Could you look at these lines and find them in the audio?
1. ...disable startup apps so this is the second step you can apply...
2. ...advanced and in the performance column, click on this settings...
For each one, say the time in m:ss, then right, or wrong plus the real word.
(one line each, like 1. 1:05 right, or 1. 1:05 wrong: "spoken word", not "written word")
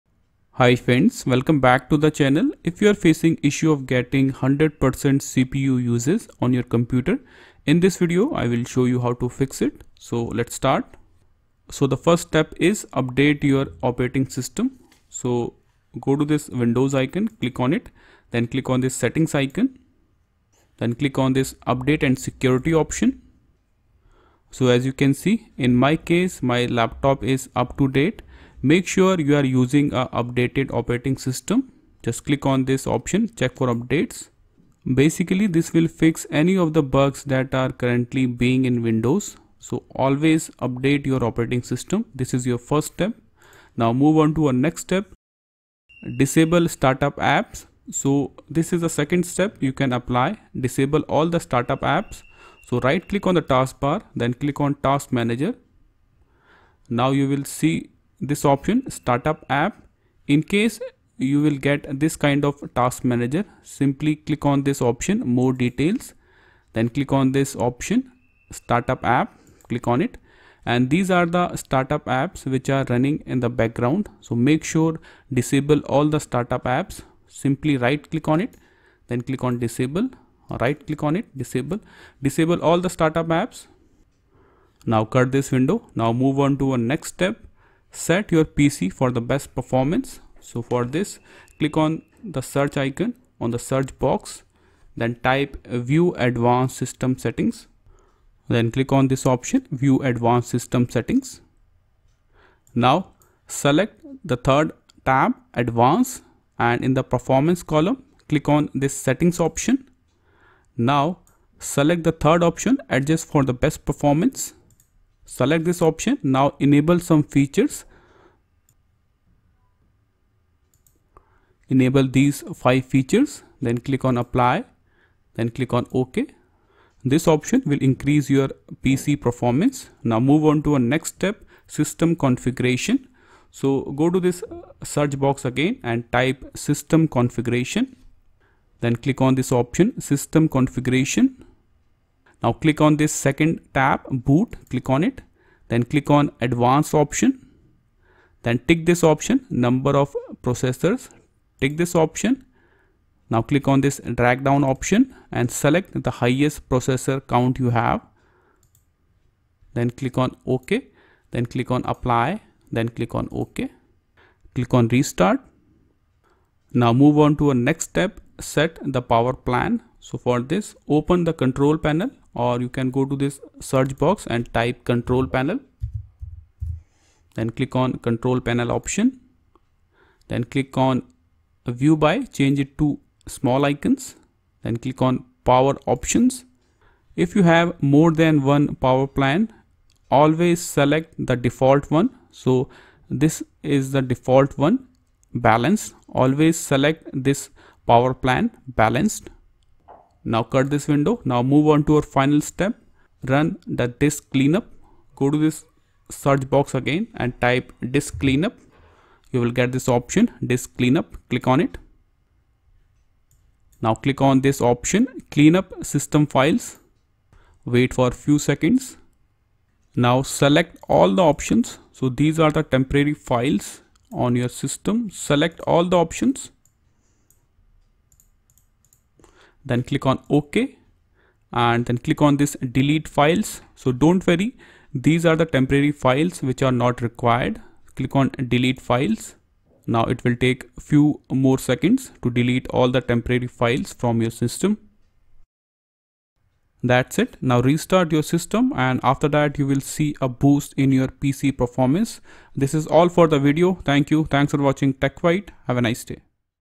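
1. 0:46 right
2. 1:45 right.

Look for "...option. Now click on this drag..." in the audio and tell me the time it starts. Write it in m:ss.
2:31.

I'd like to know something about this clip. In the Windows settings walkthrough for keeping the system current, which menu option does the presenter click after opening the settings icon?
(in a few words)
Update and security.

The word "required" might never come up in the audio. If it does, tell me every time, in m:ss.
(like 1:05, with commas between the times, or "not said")
3:57.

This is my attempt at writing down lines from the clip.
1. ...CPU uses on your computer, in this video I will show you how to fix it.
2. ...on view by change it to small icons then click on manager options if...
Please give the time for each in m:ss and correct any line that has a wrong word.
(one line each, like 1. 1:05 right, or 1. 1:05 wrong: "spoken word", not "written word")
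1. 0:05 right
2. 3:00 wrong: "power", not "manager".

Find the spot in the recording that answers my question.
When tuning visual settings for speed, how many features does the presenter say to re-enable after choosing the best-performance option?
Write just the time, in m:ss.
2:02.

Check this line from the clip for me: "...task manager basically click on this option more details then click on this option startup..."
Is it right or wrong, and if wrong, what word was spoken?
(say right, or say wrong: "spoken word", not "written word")
wrong: "simply", not "basically".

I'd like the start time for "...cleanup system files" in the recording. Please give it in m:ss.
3:35.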